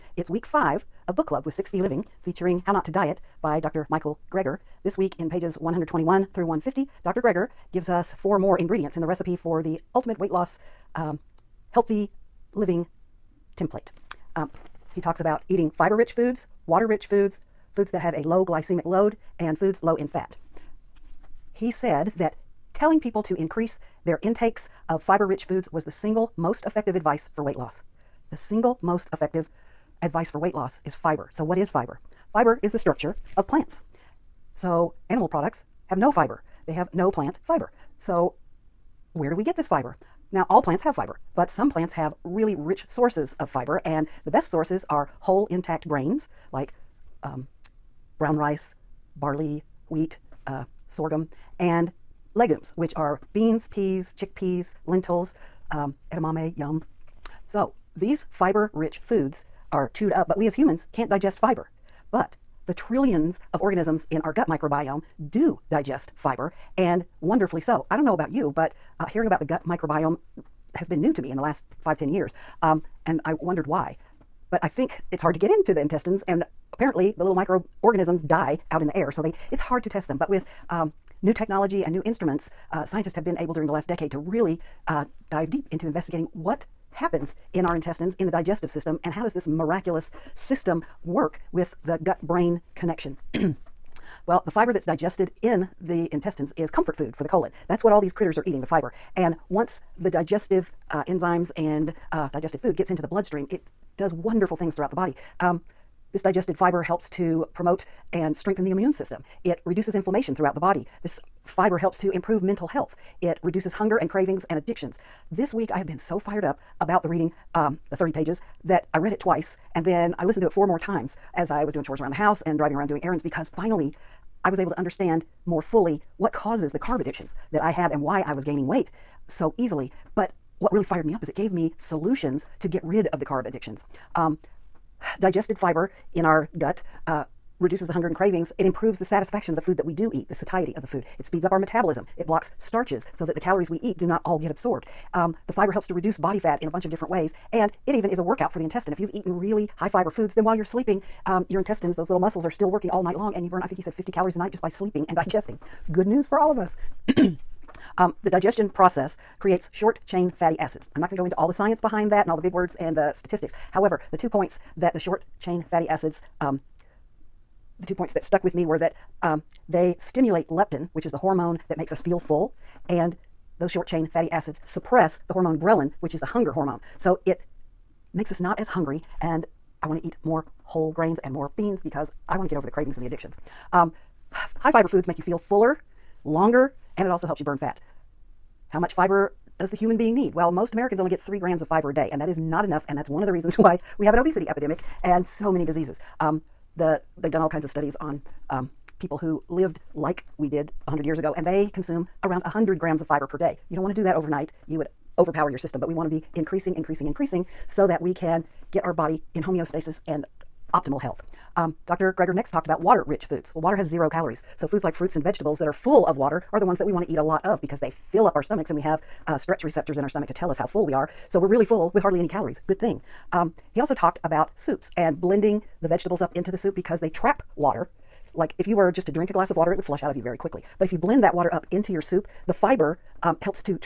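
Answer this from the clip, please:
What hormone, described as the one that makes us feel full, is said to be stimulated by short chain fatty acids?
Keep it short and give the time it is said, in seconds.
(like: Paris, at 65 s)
leptin, at 170 s.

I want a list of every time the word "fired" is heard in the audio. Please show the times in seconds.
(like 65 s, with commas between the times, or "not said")
116 s, 130 s.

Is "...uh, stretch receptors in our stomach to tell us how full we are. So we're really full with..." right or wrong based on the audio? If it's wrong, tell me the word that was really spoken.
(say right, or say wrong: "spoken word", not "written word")
right.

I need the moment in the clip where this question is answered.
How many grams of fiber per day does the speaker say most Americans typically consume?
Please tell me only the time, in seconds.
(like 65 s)
191 s.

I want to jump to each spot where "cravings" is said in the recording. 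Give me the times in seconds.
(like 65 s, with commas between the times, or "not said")
114 s, 138 s, 182 s.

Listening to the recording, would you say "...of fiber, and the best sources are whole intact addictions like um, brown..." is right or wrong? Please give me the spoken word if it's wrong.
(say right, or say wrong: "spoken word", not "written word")
wrong: "grains", not "addictions".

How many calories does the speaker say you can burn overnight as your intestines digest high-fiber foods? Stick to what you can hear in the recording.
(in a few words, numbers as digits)
50.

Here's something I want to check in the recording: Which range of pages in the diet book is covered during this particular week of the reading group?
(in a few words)
121 through 150.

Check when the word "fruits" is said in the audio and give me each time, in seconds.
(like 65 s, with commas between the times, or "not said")
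214 s.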